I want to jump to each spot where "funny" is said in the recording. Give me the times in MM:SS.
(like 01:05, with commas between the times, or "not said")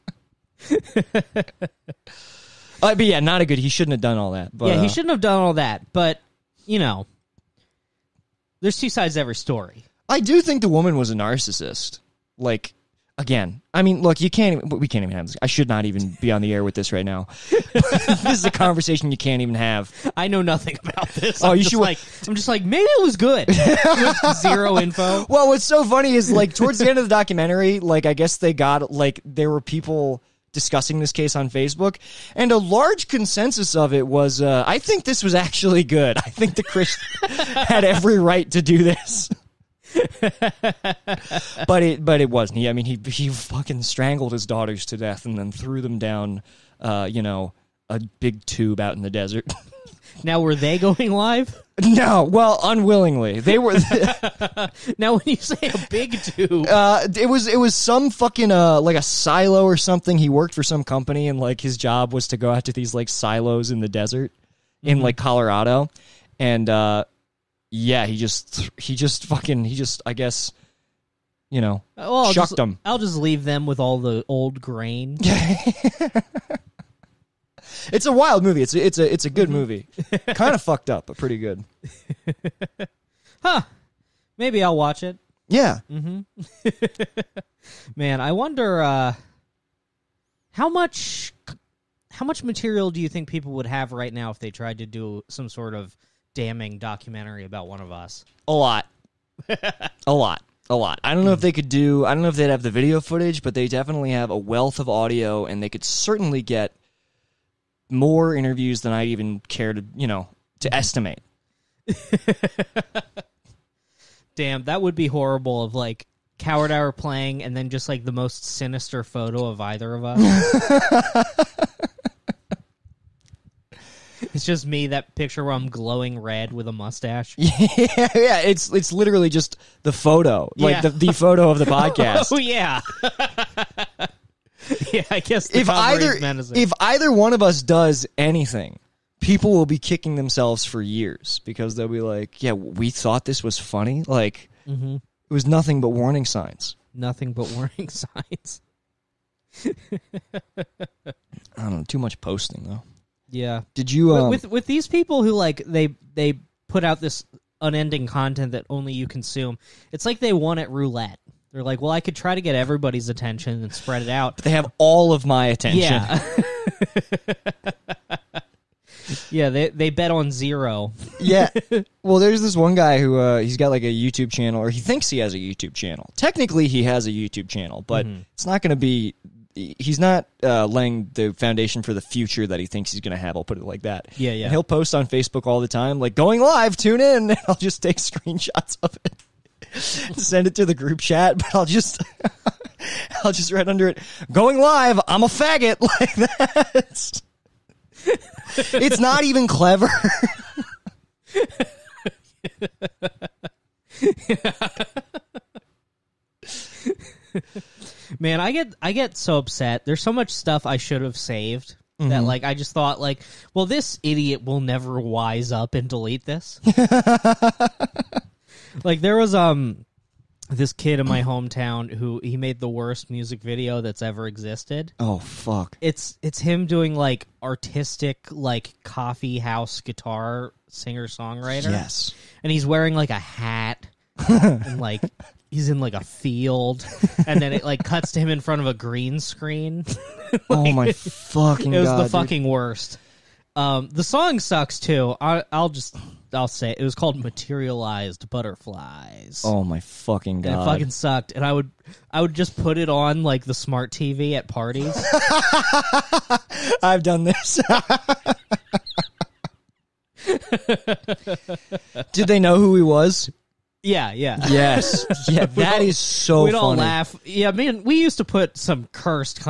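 00:25, 02:23.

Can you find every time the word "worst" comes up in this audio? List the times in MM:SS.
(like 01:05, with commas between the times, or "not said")
03:42, 04:02.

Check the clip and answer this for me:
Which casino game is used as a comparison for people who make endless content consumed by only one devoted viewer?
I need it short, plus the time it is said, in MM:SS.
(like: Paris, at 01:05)
Roulette, at 02:40.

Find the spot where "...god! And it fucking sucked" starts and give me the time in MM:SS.
04:10.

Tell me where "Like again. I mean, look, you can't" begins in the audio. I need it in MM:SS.
00:12.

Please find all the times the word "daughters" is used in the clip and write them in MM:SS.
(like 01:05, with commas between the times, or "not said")
00:44.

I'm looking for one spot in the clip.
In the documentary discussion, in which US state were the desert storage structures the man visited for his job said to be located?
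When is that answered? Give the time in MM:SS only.
01:05.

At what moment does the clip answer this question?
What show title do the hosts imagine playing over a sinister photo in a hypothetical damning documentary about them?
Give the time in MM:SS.
01:56.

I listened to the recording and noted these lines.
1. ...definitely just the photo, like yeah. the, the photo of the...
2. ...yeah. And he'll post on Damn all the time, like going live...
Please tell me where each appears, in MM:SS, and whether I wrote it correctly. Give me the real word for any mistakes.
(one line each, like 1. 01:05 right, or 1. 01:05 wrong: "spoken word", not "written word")
1. 02:08 wrong: "literally", not "definitely"
2. 03:04 wrong: "Facebook", not "Damn".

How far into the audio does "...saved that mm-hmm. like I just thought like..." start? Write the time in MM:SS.
03:31.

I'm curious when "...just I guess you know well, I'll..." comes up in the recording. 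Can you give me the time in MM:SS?
01:09.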